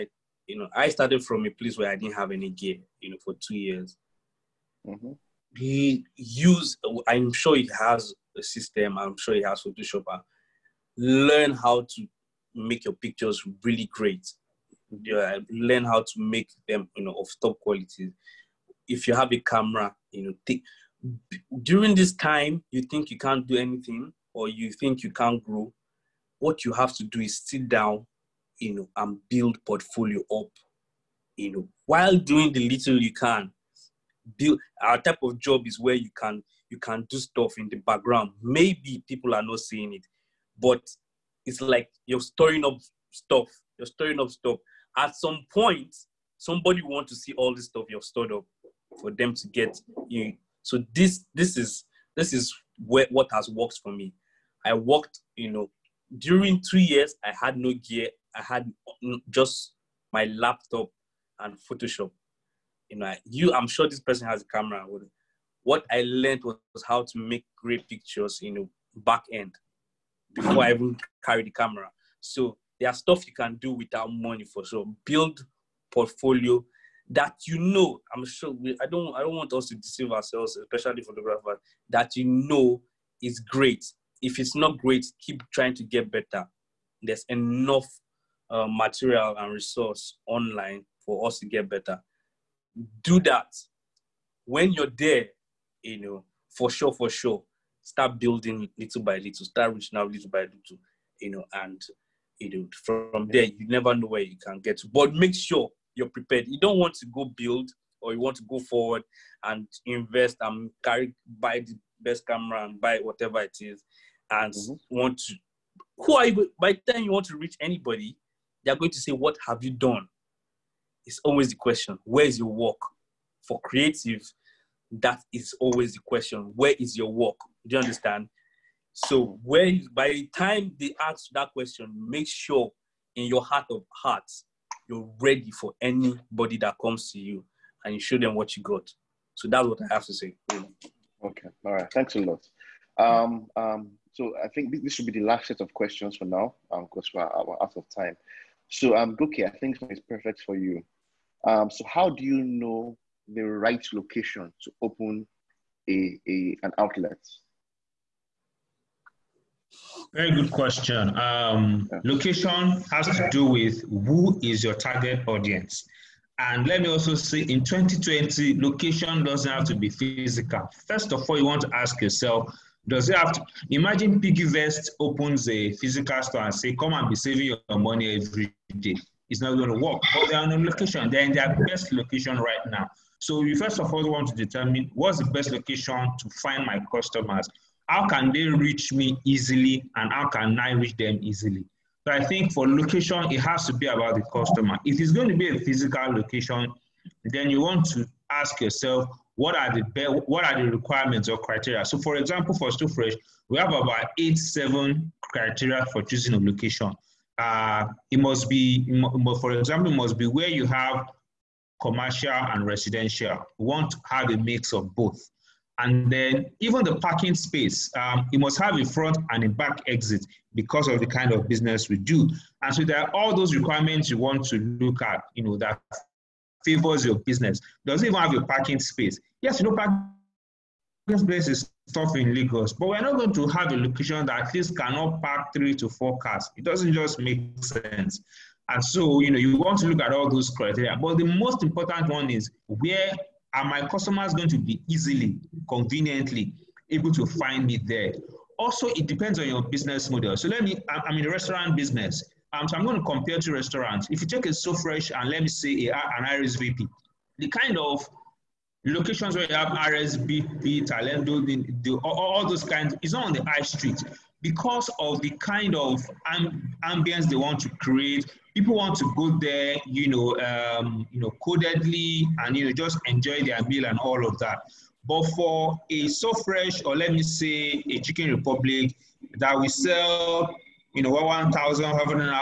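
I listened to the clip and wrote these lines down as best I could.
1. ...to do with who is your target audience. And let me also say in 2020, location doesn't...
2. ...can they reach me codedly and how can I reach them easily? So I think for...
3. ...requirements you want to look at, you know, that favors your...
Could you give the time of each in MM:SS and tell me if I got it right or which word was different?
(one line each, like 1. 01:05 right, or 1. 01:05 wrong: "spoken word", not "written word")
1. 02:43 right
2. 03:08 wrong: "easily", not "codedly"
3. 03:43 right.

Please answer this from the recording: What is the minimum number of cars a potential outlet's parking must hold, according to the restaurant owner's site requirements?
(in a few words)
3 to 4.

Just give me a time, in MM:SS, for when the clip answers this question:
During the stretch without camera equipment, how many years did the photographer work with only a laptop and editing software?
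00:56.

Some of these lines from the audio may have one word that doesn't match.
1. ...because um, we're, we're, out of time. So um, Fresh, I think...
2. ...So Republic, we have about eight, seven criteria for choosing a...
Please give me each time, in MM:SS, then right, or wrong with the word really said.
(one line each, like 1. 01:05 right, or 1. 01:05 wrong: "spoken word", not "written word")
1. 02:26 wrong: "Goke", not "Fresh"
2. 03:22 wrong: "Fresh", not "Republic".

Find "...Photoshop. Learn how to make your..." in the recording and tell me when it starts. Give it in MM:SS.
00:09.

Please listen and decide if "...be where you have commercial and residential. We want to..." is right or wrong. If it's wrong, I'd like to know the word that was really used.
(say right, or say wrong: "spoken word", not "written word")
right.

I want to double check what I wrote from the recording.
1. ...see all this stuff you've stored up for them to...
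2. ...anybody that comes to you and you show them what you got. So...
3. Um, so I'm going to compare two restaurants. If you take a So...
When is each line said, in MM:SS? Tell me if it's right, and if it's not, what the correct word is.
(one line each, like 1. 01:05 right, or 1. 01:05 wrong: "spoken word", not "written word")
1. 00:47 right
2. 02:15 right
3. 04:12 right.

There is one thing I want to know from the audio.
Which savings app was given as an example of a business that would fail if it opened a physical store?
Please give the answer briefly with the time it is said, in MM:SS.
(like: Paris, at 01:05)
PiggyVest, at 02:54.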